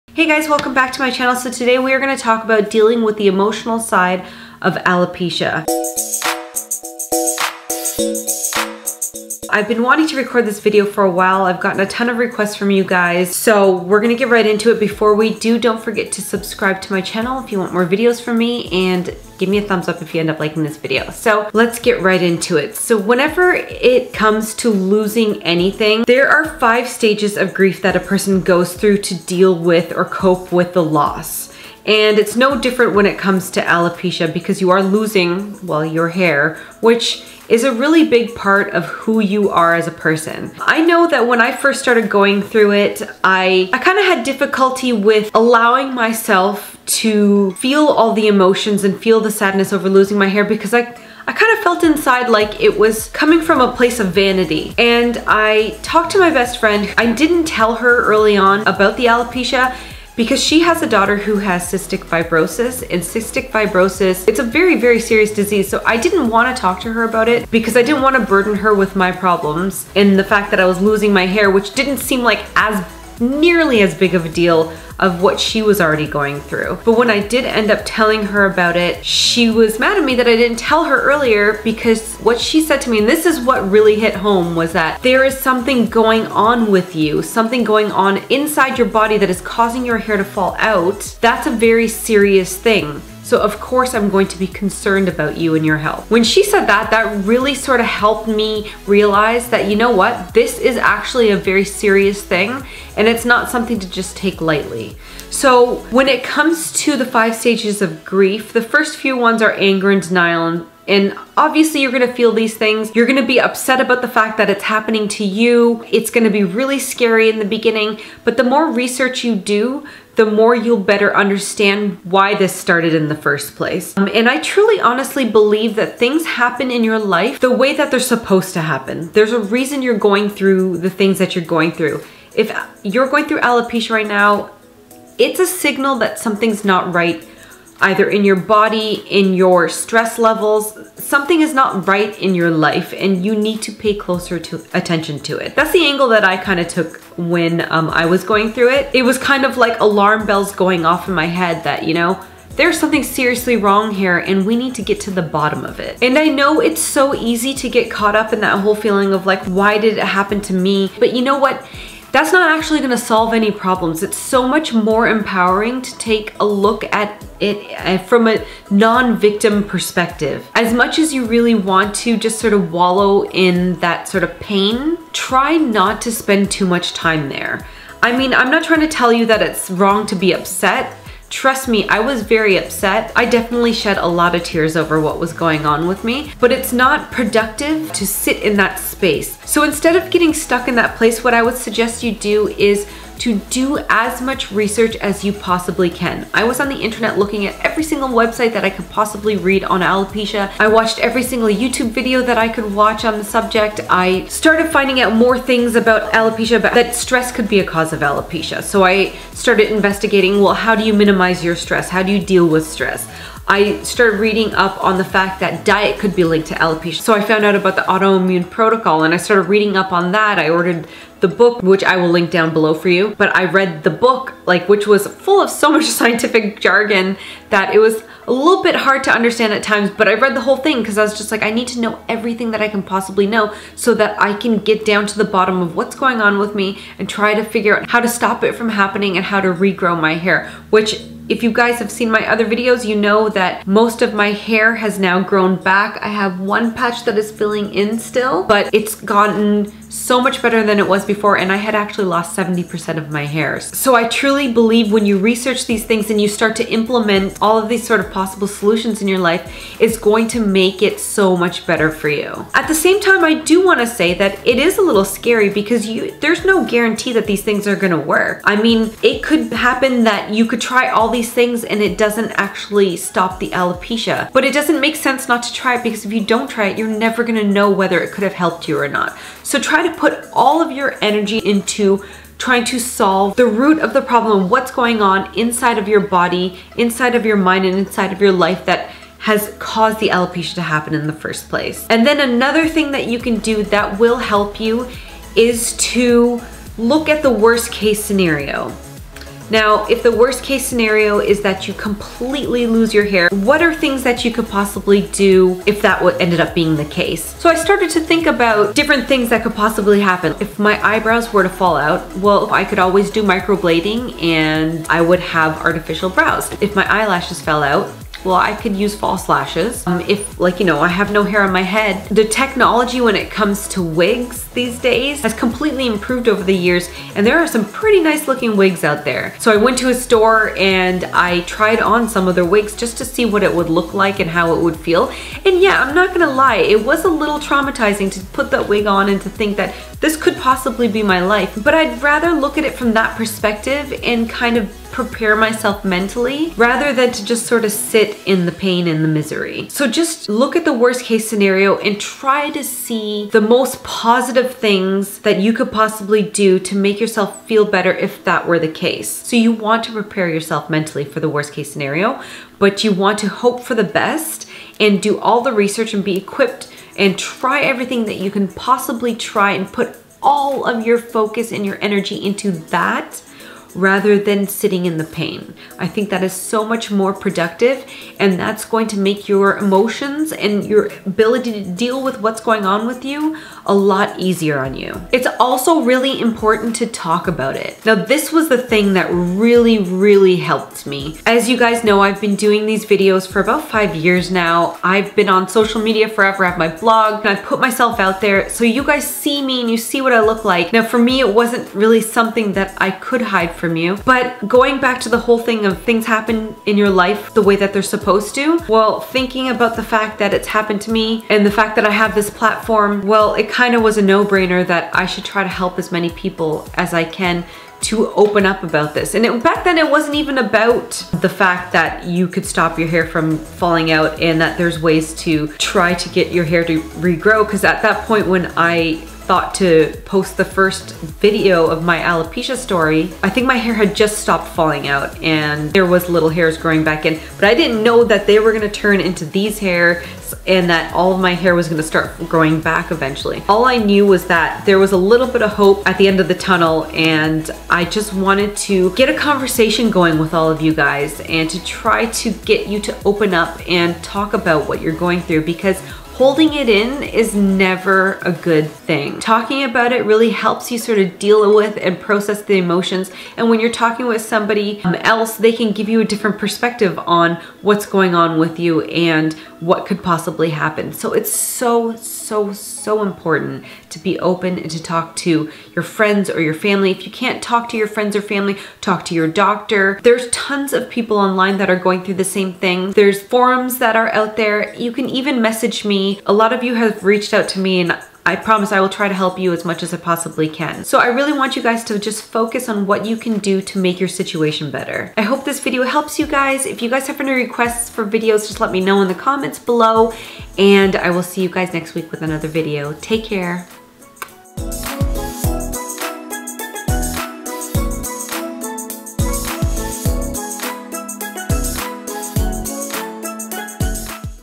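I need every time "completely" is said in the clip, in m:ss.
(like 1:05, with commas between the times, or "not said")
5:01, 5:25.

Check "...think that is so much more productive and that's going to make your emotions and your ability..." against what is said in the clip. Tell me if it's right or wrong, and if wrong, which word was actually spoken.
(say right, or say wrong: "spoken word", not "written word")
right.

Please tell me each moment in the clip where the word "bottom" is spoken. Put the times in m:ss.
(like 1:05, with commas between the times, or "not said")
2:35, 3:55.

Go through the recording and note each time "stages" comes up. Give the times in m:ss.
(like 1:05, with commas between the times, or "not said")
0:26, 1:47.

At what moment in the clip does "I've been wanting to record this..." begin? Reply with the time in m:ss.
0:09.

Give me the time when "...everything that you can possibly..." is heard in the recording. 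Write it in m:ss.
6:07.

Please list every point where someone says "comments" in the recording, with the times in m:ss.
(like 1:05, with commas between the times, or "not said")
8:19.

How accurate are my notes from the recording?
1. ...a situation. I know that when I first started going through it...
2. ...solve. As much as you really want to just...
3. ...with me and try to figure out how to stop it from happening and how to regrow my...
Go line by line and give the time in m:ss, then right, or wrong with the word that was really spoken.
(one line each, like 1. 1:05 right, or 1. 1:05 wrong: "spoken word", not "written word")
1. 0:39 wrong: "person", not "situation"
2. 2:49 wrong: "perspective", not "solve"
3. 3:56 right.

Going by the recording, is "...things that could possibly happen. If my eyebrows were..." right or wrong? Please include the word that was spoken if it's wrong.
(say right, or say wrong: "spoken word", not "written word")
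right.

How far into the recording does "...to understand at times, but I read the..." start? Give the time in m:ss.
3:49.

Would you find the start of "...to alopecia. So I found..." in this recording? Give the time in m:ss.
3:36.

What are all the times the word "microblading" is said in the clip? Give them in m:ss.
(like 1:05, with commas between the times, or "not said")
5:13.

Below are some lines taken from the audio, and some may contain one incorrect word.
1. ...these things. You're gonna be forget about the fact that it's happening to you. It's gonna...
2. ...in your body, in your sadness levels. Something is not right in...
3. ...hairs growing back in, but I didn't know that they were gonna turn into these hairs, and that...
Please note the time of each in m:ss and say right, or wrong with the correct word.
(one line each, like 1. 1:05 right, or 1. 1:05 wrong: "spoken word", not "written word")
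1. 1:52 wrong: "upset", not "forget"
2. 2:18 wrong: "stress", not "sadness"
3. 7:16 right.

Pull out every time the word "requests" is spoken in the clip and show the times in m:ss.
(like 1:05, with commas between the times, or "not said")
0:12, 8:17.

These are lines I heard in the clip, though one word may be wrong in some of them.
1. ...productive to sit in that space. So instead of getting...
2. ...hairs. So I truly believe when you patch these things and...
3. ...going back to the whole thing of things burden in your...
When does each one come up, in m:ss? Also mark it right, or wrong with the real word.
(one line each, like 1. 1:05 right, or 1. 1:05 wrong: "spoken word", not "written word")
1. 3:07 right
2. 4:13 wrong: "research", not "patch"
3. 6:44 wrong: "happen", not "burden".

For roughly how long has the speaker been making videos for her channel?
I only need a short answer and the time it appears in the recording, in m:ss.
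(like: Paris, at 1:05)
about 5 years, at 6:33.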